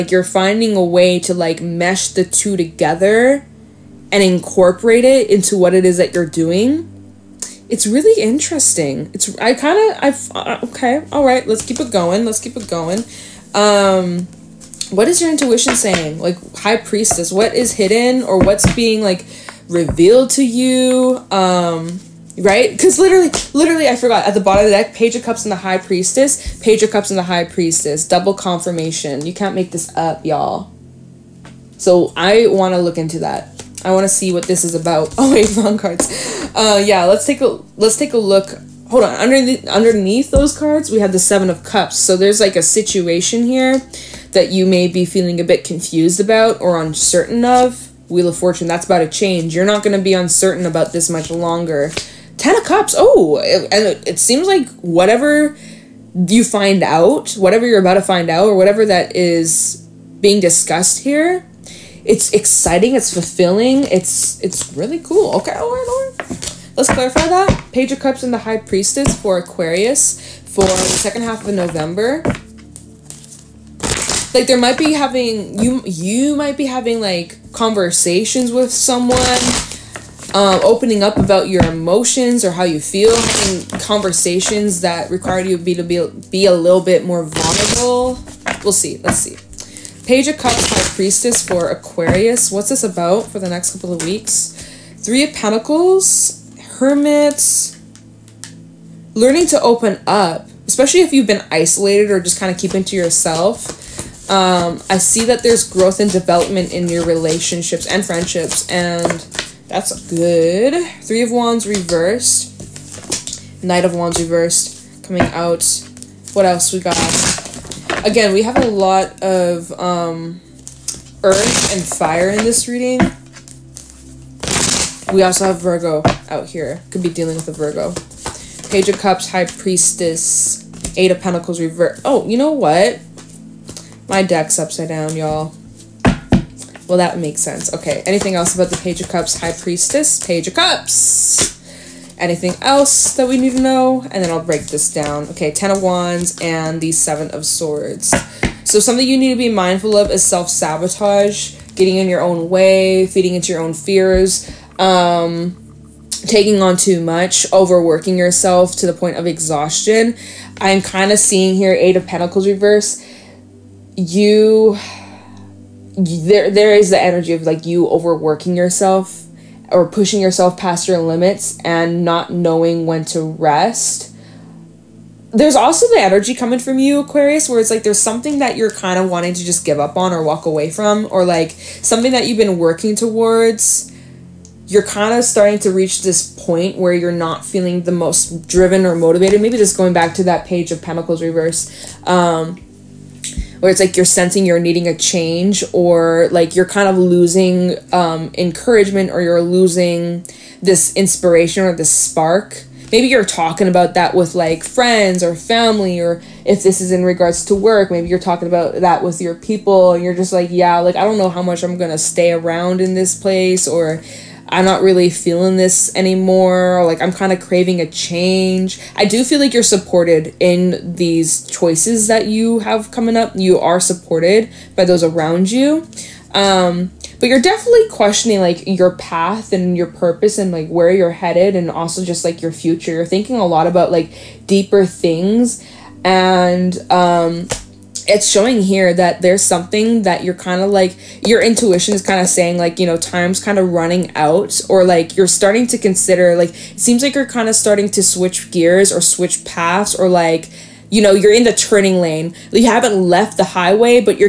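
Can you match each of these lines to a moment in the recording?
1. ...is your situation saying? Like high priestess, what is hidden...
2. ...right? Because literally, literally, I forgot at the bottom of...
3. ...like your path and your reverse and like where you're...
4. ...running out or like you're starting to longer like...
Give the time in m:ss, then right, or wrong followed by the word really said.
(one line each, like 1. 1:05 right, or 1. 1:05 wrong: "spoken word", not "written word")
1. 0:15 wrong: "intuition", not "situation"
2. 0:22 right
3. 3:48 wrong: "purpose", not "reverse"
4. 4:03 wrong: "consider", not "longer".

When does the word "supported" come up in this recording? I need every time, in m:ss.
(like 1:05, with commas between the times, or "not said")
3:39, 3:43.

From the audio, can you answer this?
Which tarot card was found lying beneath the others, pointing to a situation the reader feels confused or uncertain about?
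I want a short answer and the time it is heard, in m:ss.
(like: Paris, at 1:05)
Seven of Cups, at 0:41.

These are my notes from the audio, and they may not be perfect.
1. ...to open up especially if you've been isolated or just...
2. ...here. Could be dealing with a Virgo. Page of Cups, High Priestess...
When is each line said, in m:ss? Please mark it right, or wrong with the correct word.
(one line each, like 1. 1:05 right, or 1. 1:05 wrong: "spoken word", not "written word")
1. 1:39 right
2. 2:06 right.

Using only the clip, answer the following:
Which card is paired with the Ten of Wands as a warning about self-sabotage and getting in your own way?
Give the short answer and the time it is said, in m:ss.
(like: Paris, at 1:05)
Seven of Swords, at 2:26.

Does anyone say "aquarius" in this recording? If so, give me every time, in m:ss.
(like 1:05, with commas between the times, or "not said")
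1:09, 1:31, 2:57.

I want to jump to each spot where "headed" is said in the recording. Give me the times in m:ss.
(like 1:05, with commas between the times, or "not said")
3:51.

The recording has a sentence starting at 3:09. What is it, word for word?
Maybe just going back to that page of Pentacles reverse.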